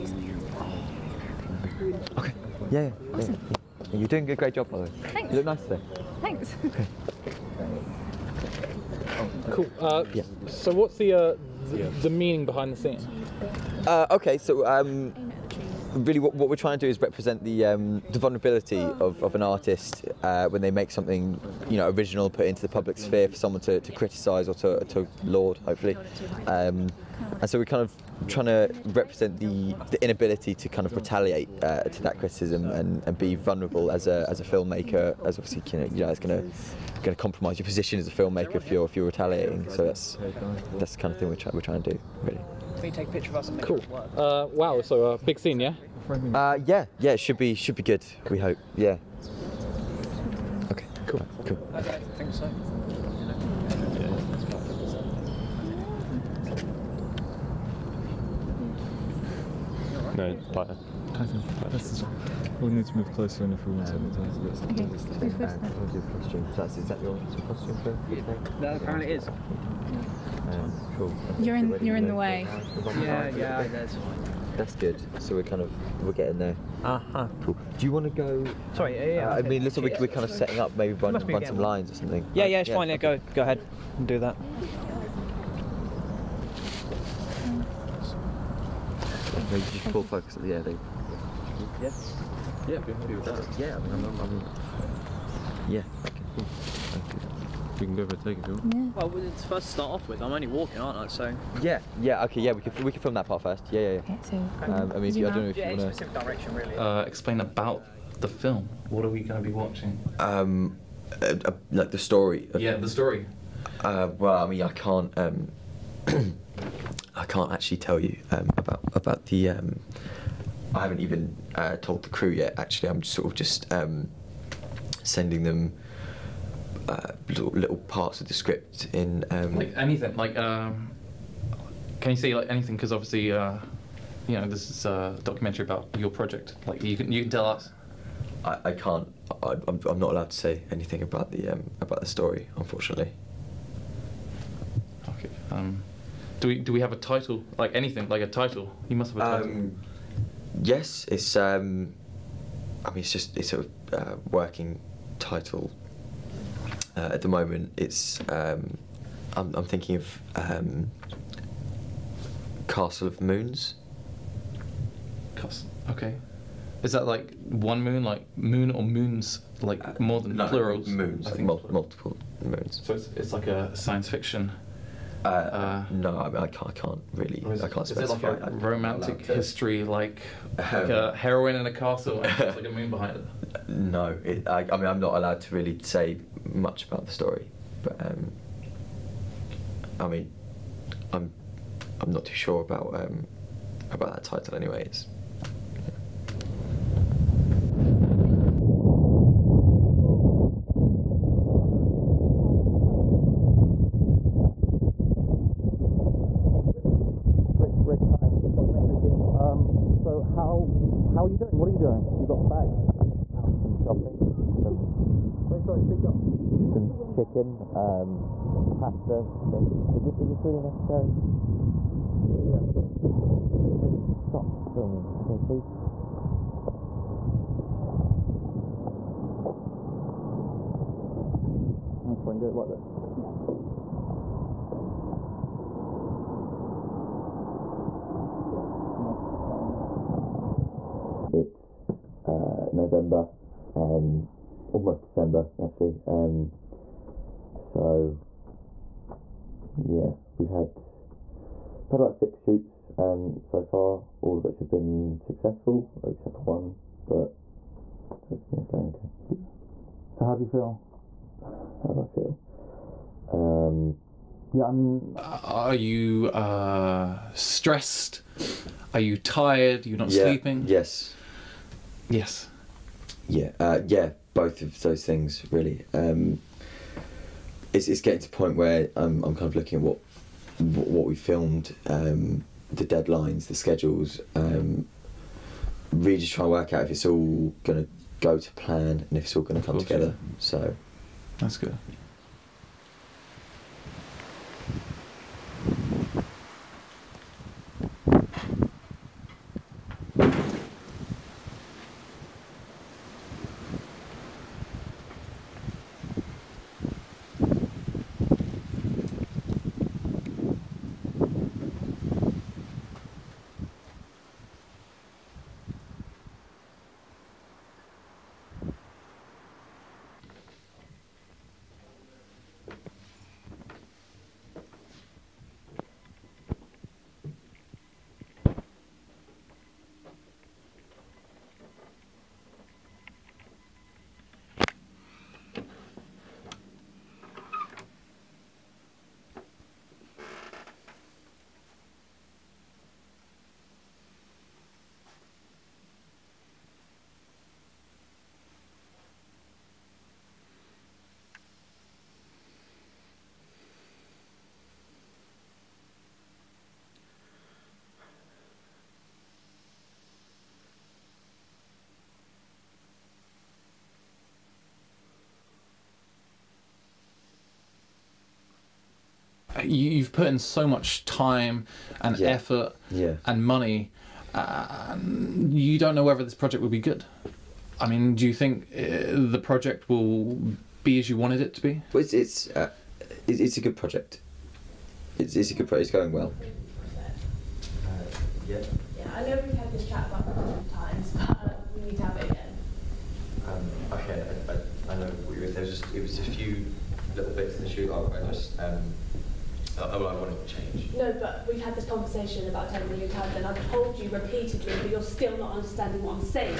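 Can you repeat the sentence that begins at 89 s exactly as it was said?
No, you just pull focus at the air, they...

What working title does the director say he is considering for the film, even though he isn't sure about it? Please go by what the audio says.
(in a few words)
Castle of Moons.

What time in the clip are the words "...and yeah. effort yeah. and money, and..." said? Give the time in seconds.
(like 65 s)
372 s.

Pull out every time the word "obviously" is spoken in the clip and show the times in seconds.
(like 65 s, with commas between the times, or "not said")
35 s, 132 s.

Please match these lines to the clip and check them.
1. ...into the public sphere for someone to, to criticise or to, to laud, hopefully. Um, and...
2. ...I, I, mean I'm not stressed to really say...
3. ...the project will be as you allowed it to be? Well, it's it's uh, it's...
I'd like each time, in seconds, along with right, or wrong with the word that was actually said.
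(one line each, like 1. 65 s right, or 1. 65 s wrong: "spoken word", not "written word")
1. 22 s right
2. 184 s wrong: "allowed", not "stressed"
3. 379 s wrong: "wanted", not "allowed".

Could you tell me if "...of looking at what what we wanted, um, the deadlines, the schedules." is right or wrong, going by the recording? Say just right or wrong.
wrong.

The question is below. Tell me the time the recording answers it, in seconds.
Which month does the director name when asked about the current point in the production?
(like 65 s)
242 s.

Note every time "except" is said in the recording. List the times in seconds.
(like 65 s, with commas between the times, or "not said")
256 s.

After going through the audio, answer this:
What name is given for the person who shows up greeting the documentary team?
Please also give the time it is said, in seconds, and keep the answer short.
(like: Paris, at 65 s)
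Rick, at 207 s.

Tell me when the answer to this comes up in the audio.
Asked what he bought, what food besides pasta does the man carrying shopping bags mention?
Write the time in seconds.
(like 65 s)
217 s.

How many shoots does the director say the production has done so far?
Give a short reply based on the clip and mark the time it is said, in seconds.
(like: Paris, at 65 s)
6, at 252 s.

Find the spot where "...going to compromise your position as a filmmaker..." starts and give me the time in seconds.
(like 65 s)
37 s.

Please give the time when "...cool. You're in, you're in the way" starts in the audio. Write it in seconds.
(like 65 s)
70 s.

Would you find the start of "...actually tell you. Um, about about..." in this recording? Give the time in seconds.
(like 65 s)
117 s.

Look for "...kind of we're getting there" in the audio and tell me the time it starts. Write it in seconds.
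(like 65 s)
75 s.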